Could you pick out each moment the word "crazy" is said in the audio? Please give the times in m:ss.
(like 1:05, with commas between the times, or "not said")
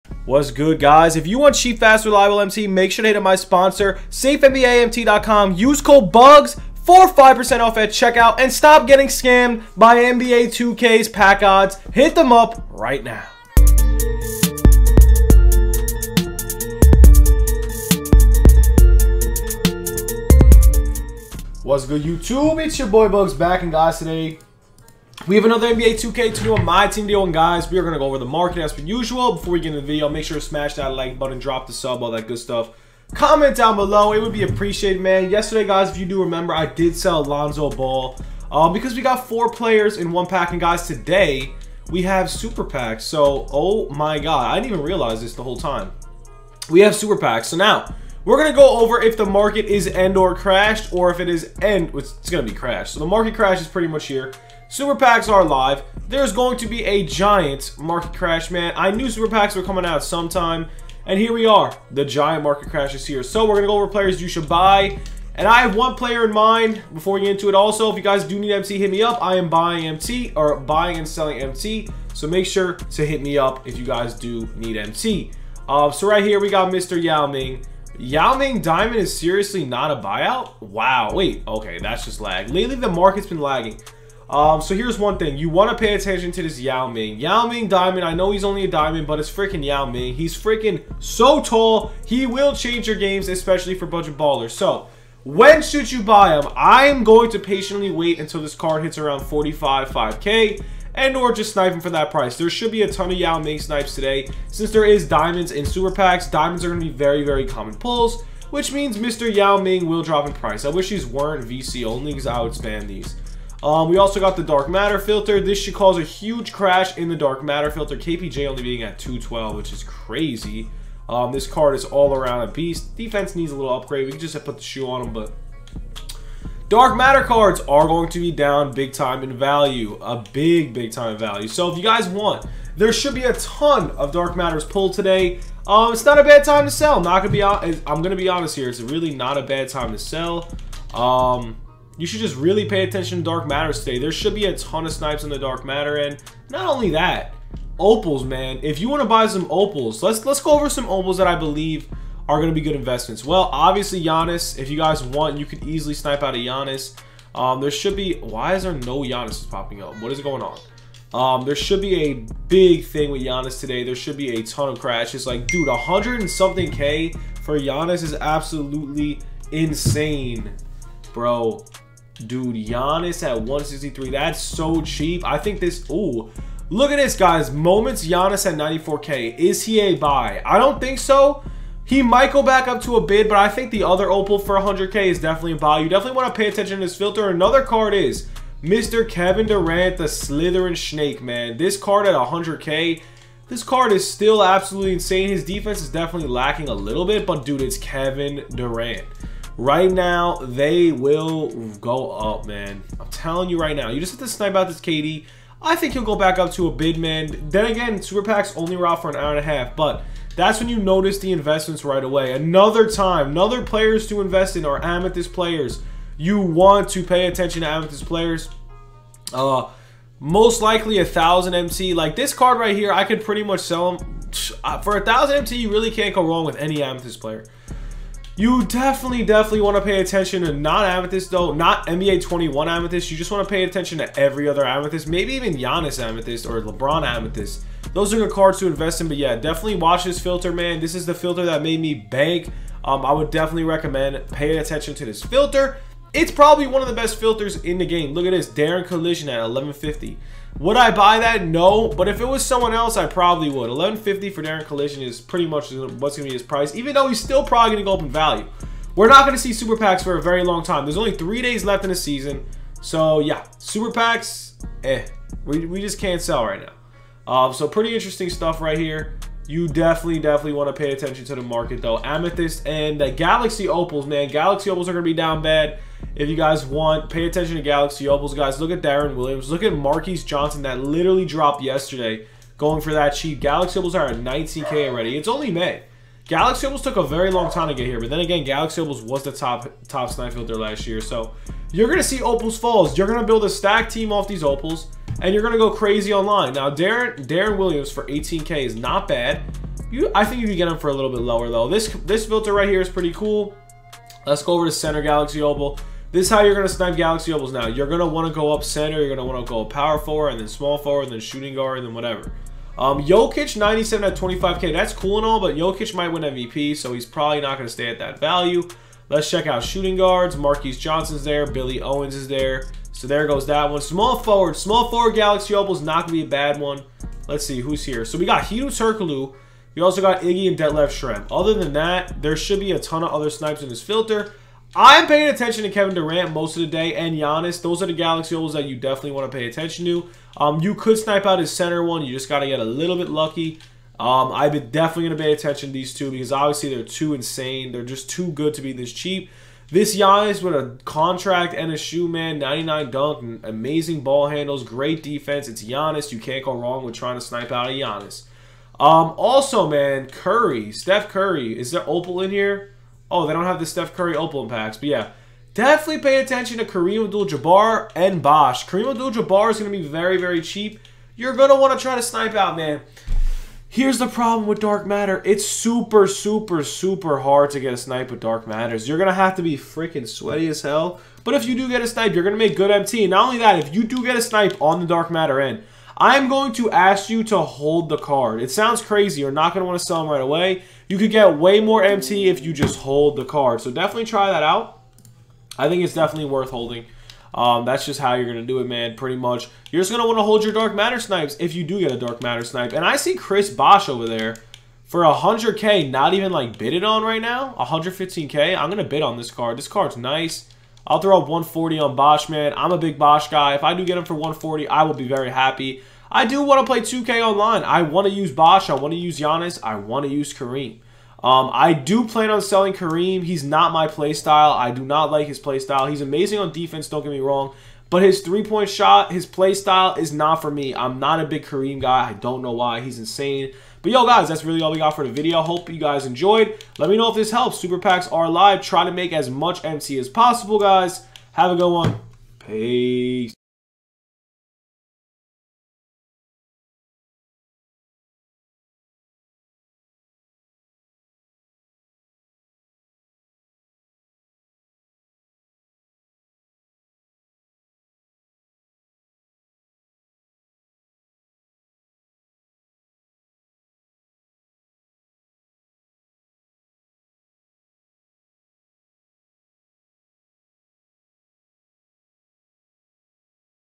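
1:59, 4:55, 6:28.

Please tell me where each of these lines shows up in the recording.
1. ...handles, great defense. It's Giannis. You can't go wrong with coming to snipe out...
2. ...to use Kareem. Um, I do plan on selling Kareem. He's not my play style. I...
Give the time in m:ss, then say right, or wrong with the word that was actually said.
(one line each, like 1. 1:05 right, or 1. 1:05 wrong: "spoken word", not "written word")
1. 5:54 wrong: "trying", not "coming"
2. 7:00 right.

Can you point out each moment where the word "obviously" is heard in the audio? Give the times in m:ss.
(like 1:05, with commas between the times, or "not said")
2:33, 5:46.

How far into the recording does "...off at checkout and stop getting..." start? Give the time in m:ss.
0:07.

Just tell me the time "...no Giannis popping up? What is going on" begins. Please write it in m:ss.
2:38.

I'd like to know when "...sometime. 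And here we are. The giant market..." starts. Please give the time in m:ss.
1:00.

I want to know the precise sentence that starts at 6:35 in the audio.
I think it's definitely worth holding.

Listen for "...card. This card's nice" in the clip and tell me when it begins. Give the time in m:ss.
6:49.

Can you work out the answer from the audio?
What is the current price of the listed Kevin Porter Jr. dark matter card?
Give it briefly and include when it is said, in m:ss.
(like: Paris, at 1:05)
212, at 1:58.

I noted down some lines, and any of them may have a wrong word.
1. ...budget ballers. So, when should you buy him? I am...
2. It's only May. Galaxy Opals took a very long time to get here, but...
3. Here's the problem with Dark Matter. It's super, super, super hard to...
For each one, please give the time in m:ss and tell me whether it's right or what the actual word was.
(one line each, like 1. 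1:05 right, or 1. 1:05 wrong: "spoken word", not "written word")
1. 1:33 right
2. 4:45 right
3. 6:13 right.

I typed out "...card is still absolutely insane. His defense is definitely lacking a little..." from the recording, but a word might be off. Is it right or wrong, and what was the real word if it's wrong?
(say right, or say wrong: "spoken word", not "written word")
right.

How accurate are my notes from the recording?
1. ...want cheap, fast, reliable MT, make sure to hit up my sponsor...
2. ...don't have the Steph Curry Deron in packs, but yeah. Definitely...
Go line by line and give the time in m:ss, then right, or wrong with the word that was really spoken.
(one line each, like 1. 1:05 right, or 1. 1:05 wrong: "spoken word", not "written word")
1. 0:01 right
2. 6:03 wrong: "Opal", not "Deron".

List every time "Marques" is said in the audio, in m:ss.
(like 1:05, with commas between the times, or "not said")
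4:39, 5:20.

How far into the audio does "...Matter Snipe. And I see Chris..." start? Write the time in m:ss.
6:42.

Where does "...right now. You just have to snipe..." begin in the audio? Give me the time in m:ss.
3:23.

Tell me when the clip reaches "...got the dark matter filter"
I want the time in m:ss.
1:54.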